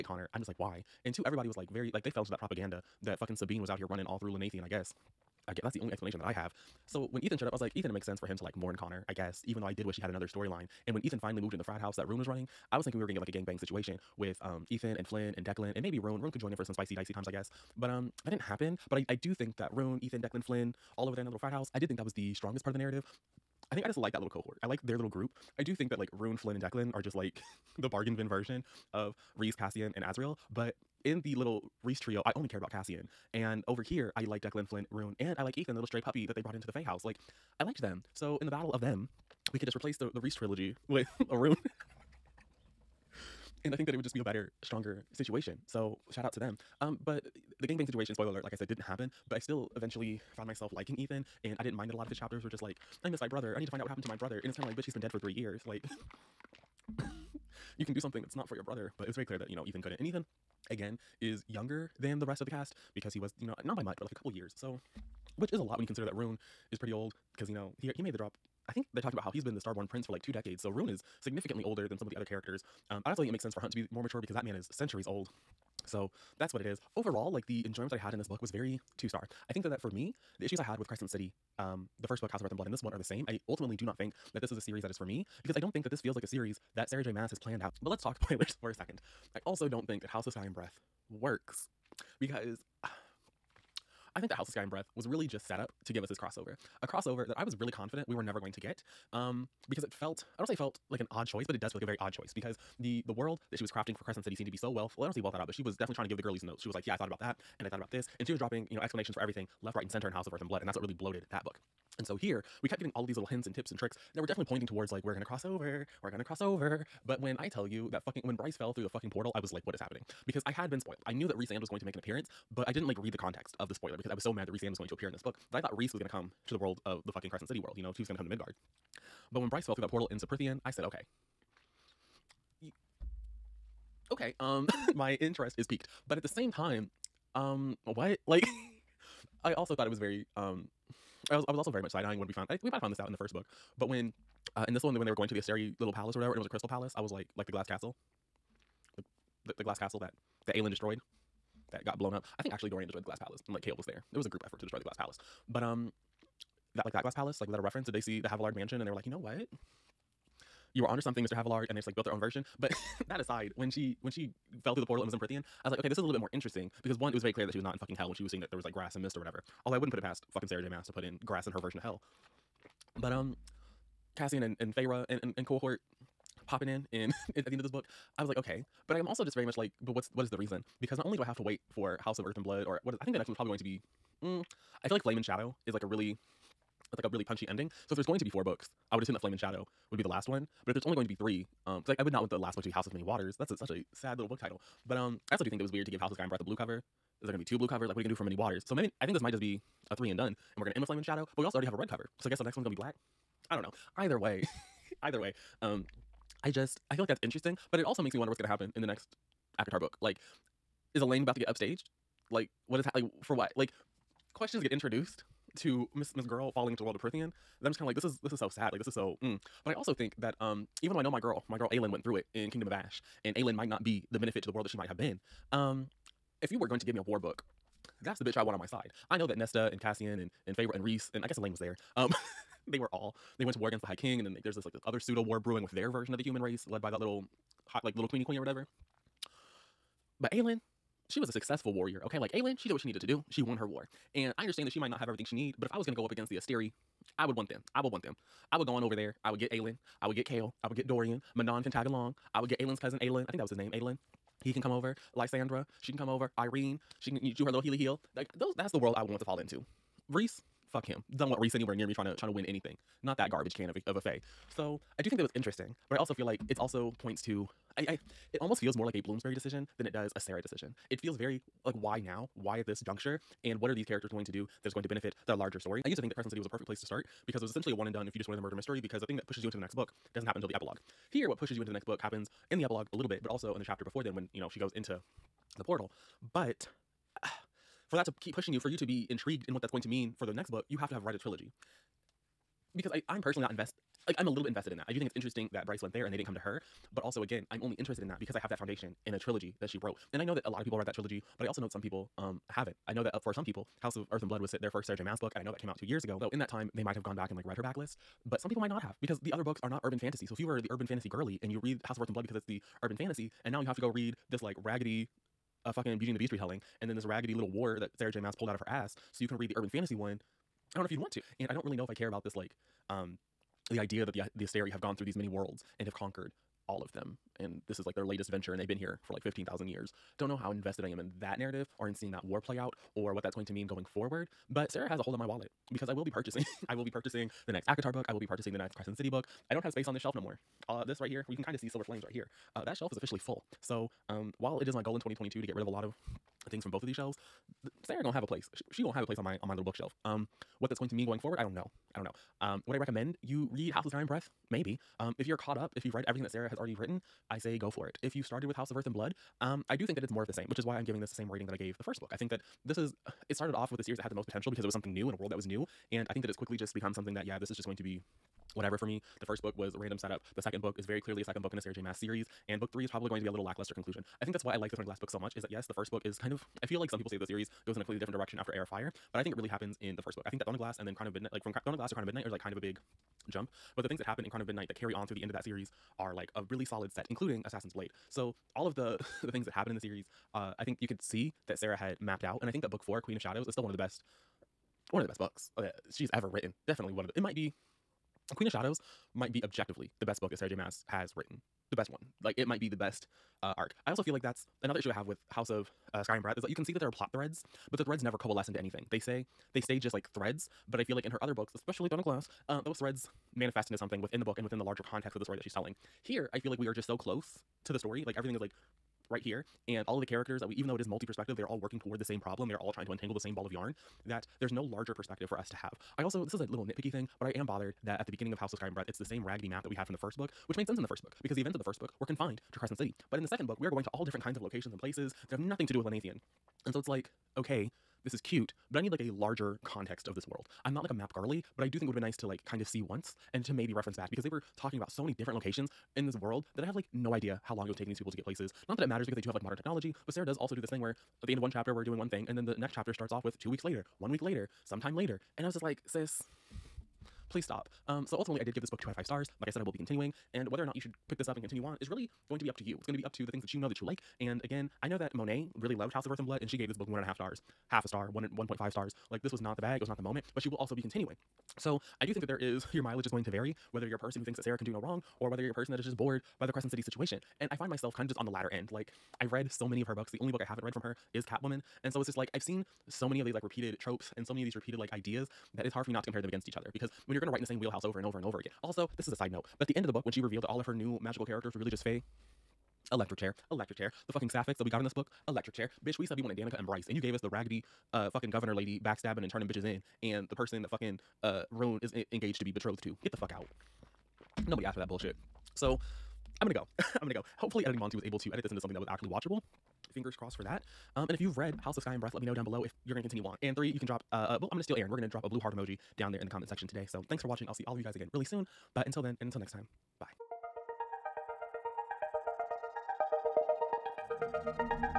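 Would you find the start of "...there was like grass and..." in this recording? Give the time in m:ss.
2:48.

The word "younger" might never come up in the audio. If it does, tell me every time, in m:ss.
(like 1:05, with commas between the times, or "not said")
1:01.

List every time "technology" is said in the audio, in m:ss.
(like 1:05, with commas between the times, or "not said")
7:29.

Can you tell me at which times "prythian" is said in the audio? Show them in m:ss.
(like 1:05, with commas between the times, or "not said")
2:10, 2:45, 3:36.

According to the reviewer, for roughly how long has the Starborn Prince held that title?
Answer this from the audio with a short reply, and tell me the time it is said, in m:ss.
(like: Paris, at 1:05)
two decades, at 1:10.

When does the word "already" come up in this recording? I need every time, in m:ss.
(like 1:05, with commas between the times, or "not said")
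3:21, 5:56.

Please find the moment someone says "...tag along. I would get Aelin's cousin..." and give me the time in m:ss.
4:11.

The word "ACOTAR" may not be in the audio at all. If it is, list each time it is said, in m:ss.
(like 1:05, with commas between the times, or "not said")
3:29, 5:37.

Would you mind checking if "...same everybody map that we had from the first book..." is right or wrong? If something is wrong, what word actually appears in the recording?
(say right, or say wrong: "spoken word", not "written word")
wrong: "raggedy", not "everybody".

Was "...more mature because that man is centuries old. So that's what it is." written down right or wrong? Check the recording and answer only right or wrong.
right.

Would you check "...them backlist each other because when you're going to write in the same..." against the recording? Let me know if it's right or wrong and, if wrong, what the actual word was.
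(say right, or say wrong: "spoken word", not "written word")
wrong: "against", not "backlist".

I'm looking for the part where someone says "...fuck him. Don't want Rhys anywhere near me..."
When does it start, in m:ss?
4:20.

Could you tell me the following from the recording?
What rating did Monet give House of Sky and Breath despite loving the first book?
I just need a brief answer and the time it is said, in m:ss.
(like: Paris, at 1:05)
1.5 stars, at 7:48.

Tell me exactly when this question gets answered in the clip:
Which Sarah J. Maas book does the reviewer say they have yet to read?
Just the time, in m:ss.
8:01.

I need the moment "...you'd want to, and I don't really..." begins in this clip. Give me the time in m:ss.
5:20.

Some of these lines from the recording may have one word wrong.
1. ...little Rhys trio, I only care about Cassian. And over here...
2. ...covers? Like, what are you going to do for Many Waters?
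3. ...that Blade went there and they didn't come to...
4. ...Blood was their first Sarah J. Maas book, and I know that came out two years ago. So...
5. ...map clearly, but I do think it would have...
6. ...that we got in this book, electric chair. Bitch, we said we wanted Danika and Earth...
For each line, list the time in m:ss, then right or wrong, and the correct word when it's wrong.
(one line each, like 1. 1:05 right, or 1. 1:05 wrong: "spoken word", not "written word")
1. 0:31 right
2. 3:17 right
3. 4:55 wrong: "Bryce", not "Blade"
4. 5:04 right
5. 7:20 wrong: "girly", not "clearly"
6. 8:14 wrong: "Bryce", not "Earth".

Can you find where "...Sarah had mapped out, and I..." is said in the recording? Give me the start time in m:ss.
6:31.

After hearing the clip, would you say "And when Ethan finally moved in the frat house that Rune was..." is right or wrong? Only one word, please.
right.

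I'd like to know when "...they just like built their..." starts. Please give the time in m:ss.
2:41.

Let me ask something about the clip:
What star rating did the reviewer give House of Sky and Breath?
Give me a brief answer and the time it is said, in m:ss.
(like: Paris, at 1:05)
2 out of 5, at 7:38.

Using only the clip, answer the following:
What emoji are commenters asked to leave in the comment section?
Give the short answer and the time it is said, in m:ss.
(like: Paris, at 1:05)
blue heart, at 8:35.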